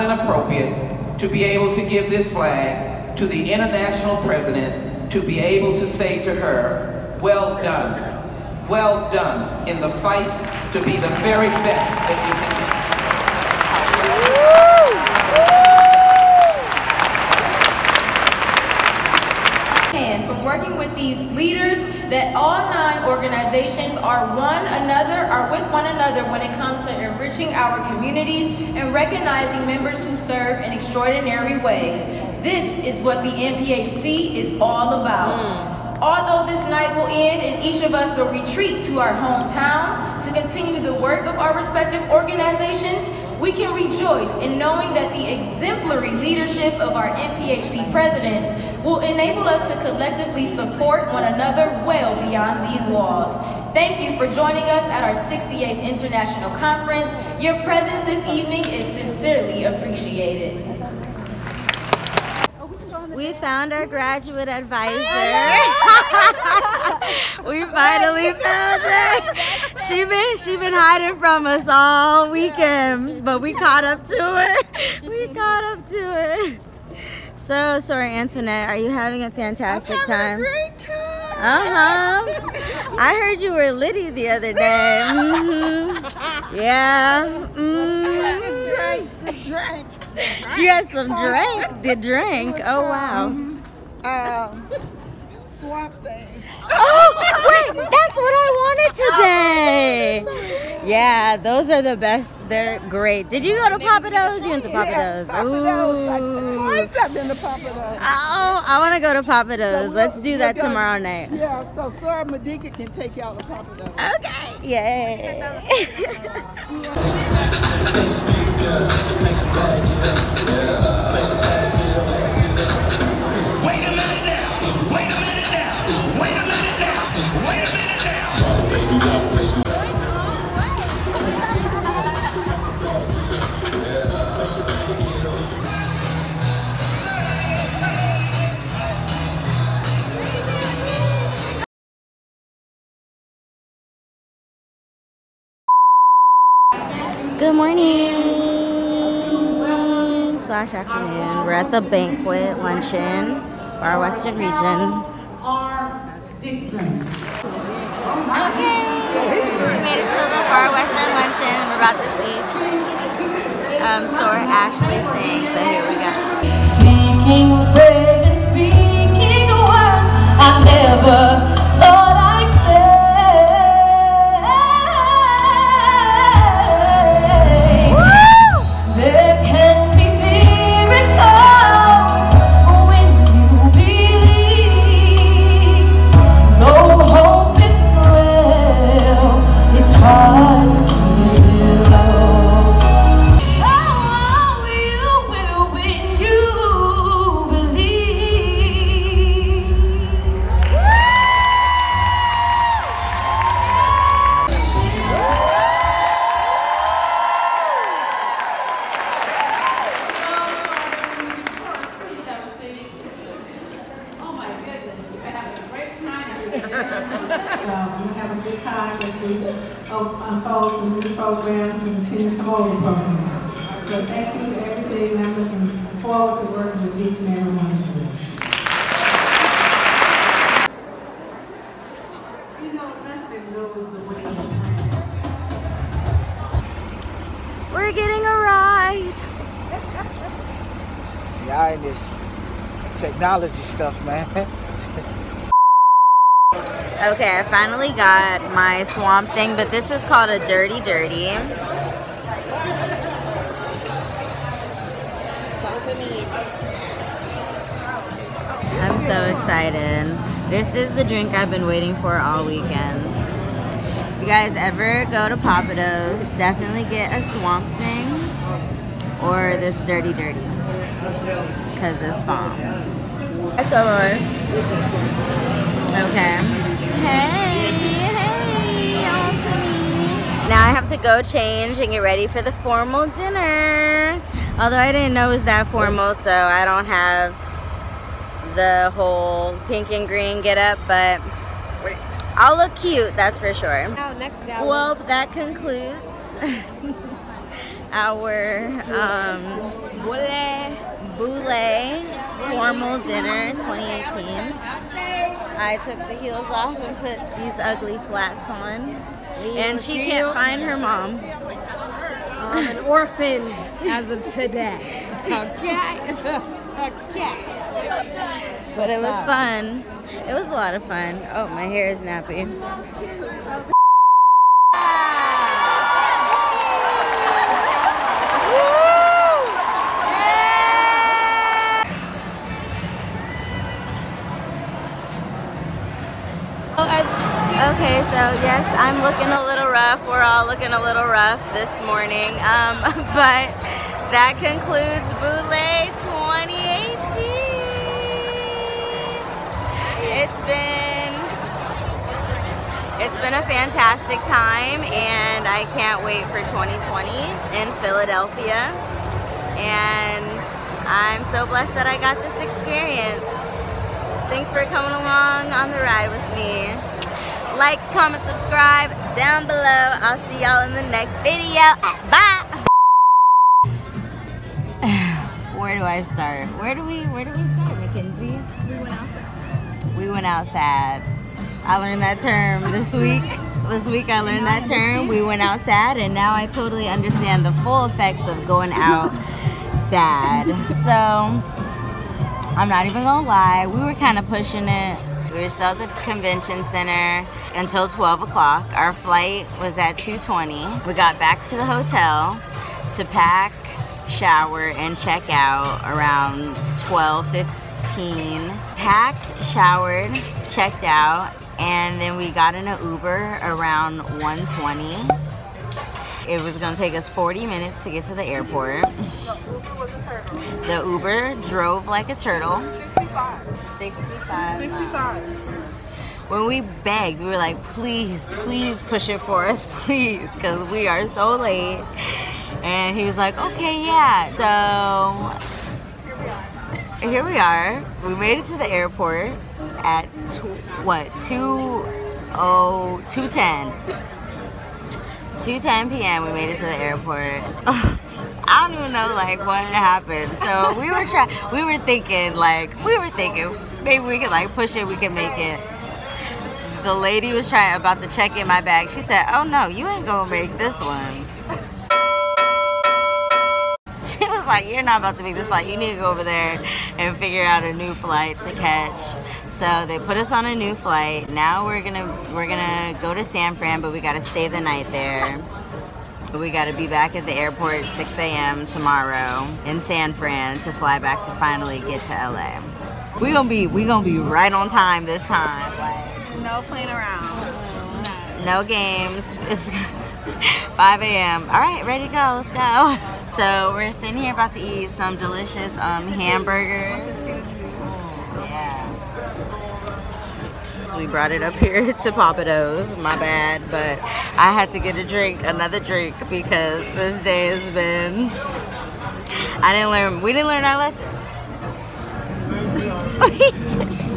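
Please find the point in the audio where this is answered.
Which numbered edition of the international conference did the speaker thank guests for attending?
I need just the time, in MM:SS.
00:55.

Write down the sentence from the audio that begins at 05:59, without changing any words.
And I'm so blessed that I got this experience.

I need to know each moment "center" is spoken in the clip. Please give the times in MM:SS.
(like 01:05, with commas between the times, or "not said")
06:36.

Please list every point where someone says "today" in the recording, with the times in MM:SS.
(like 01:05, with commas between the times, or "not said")
01:40, 05:14.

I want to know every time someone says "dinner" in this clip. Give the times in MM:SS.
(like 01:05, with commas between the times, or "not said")
04:43, 05:03.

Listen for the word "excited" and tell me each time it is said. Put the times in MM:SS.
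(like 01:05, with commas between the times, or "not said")
04:19.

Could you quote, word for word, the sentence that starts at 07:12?
And he was like, okay, yeah.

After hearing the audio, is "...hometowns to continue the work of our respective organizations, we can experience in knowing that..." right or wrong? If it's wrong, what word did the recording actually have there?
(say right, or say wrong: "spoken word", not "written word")
wrong: "rejoice", not "experience".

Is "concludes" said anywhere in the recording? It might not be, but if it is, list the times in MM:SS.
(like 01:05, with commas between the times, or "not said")
04:55, 05:44.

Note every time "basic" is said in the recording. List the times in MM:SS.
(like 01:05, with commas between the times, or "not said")
not said.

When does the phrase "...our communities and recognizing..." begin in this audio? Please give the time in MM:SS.
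00:27.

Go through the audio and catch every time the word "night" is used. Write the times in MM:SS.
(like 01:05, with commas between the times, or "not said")
00:36, 01:50, 07:54.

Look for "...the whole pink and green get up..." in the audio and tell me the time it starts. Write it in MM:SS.
04:48.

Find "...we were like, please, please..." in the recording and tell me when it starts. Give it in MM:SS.
07:07.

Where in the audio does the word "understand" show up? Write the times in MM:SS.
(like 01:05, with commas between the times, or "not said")
06:26.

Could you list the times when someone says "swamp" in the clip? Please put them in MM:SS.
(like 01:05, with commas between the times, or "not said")
04:08, 04:27.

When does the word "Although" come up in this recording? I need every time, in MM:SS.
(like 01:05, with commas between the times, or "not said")
00:36, 04:44.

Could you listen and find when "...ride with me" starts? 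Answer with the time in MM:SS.
06:05.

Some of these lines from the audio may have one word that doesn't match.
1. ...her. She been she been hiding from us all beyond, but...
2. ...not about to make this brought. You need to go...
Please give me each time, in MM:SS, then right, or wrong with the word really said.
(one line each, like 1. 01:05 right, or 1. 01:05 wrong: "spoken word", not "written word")
1. 01:08 wrong: "weekend", not "beyond"
2. 07:44 wrong: "flight", not "brought".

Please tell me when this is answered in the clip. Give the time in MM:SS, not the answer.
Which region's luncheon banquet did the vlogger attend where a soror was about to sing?
02:40.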